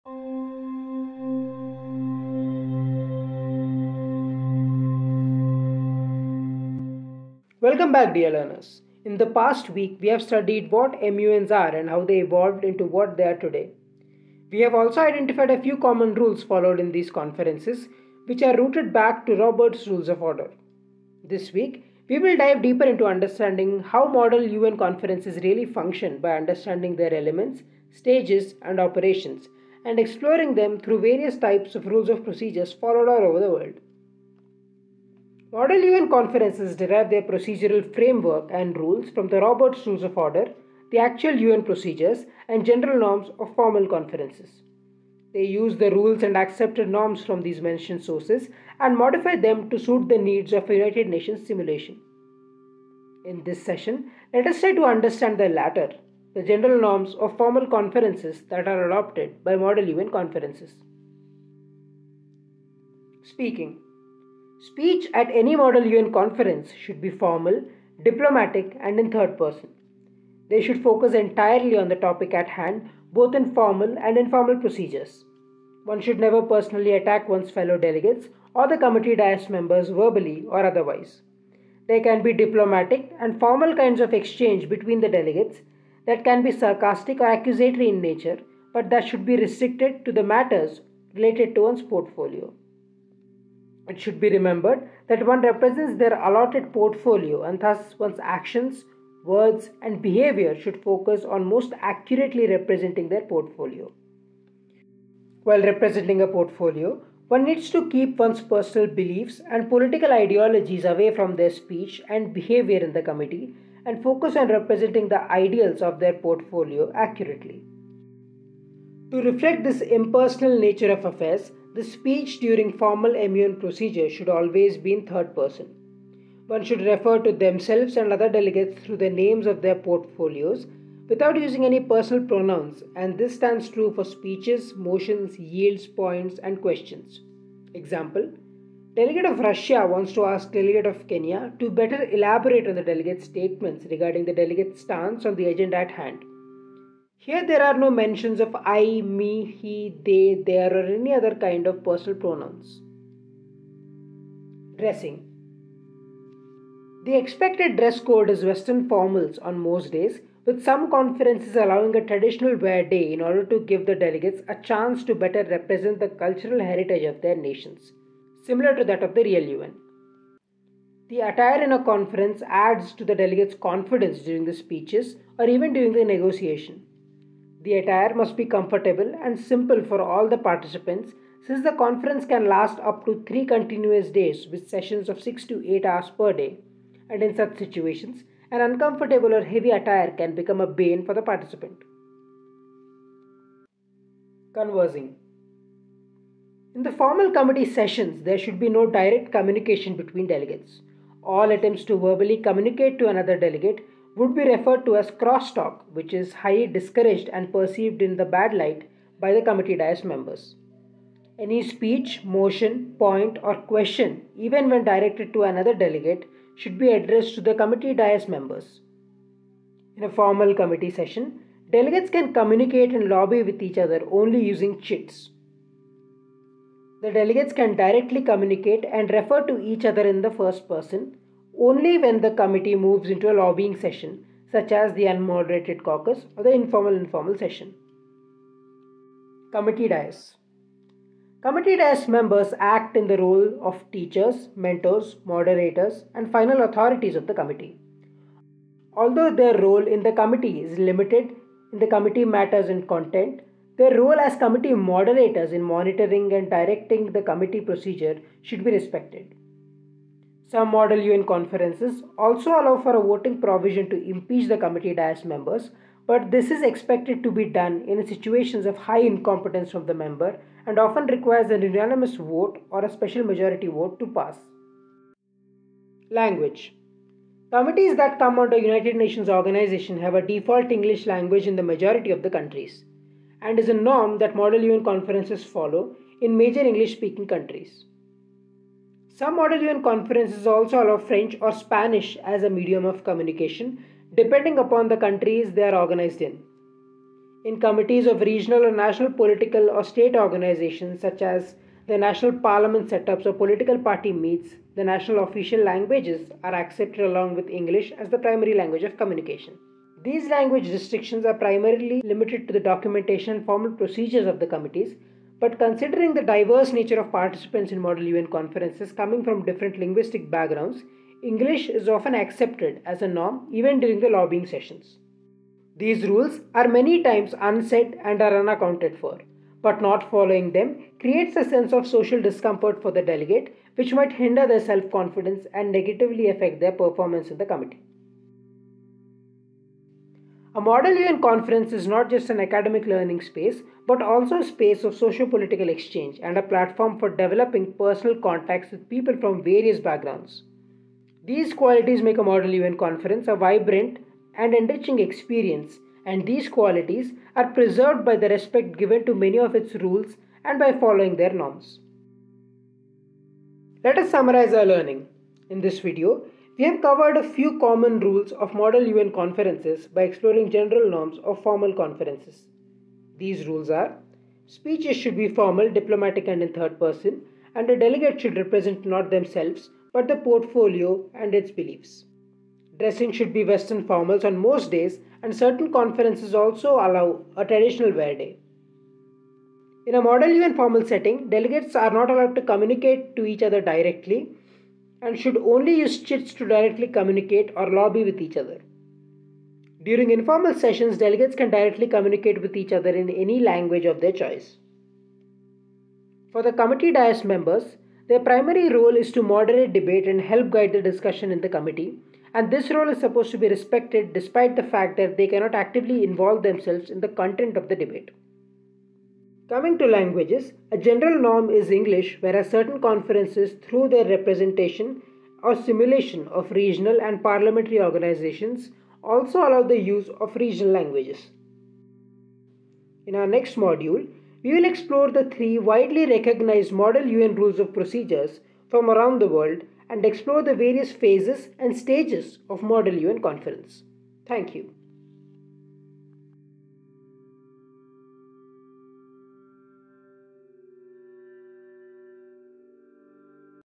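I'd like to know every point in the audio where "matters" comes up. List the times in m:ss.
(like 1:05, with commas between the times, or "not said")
1:30, 4:12.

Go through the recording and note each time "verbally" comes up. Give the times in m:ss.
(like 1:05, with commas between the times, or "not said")
1:19, 3:21.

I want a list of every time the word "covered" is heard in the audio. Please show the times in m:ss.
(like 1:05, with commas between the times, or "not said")
6:06.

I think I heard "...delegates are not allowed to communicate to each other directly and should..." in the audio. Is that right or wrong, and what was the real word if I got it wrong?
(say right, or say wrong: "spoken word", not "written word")
right.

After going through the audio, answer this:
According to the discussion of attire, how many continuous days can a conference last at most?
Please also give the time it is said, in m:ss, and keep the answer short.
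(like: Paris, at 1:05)
3, at 3:03.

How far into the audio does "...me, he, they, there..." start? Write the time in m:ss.
2:29.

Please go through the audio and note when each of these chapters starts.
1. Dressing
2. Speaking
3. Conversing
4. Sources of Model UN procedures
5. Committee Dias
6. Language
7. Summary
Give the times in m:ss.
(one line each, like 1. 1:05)
1. 2:35
2. 1:04
3. 3:14
4. 0:38
5. 3:59
6. 4:37
7. 6:05.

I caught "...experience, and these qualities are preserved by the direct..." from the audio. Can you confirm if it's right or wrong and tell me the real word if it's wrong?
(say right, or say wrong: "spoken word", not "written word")
wrong: "respect", not "direct".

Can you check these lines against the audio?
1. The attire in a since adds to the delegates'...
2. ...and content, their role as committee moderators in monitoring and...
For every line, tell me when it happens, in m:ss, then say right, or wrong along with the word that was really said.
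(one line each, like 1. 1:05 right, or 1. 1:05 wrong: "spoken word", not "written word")
1. 2:51 wrong: "conference", not "since"
2. 4:12 right.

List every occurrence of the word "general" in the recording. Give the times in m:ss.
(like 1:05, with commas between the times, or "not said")
0:42, 0:56, 6:10, 7:00.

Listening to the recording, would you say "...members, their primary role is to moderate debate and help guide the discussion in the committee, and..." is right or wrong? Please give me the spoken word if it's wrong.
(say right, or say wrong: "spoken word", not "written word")
right.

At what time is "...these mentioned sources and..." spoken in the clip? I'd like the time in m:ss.
0:47.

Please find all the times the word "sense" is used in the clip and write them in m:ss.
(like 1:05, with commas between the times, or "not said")
5:31.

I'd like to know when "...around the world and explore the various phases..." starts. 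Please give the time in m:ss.
7:18.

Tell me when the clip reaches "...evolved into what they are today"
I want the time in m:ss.
0:12.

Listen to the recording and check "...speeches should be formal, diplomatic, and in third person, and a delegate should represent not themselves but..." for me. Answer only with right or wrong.
right.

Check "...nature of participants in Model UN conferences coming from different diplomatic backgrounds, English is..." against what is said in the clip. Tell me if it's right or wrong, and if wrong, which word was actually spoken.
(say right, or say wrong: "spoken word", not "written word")
wrong: "linguistic", not "diplomatic".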